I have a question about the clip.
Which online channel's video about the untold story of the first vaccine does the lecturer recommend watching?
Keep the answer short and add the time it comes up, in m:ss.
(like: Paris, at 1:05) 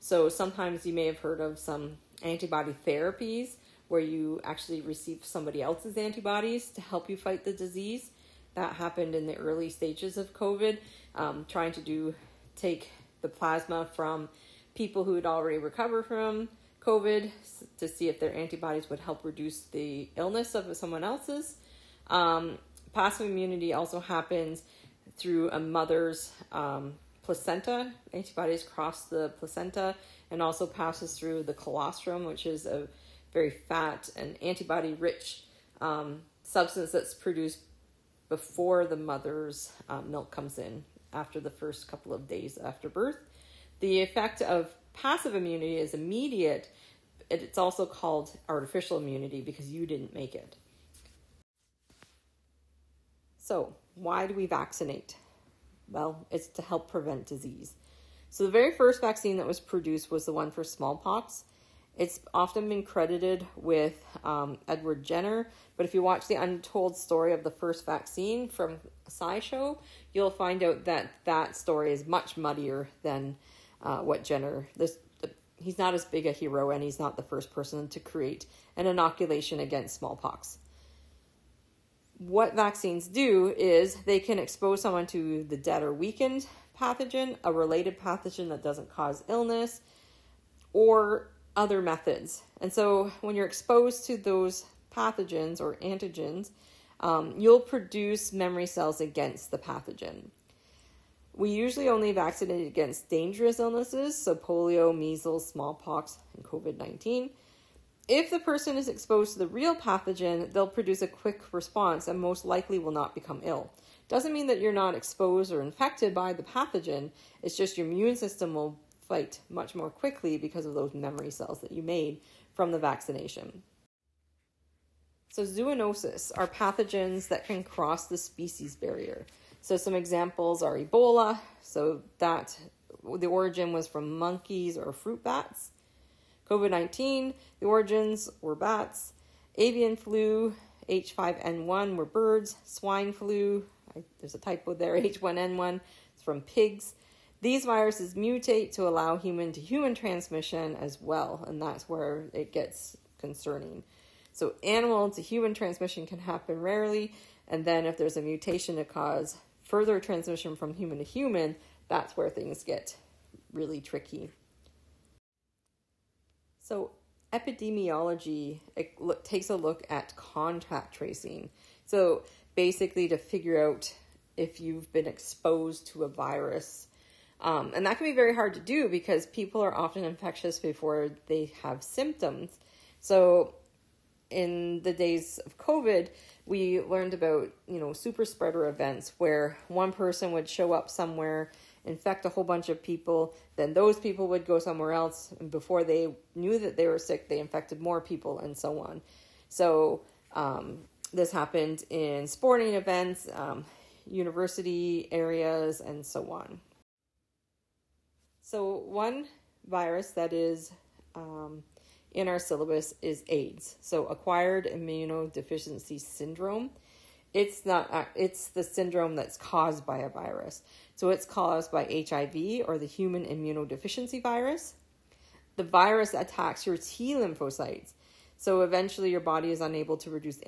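SciShow, at 1:09.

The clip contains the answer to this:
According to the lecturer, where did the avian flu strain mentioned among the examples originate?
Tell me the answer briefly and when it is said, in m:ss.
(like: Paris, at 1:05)
birds, at 2:22.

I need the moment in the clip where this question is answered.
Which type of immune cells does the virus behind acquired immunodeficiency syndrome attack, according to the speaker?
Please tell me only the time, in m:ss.
3:46.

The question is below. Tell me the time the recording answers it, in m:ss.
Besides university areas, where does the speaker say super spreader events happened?
3:22.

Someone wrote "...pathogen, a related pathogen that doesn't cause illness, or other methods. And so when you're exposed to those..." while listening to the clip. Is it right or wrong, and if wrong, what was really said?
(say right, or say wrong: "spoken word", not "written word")
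right.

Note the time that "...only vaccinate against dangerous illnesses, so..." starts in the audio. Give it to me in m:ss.
1:41.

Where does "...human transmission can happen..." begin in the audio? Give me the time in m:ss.
2:35.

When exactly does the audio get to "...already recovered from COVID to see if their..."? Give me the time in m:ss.
0:15.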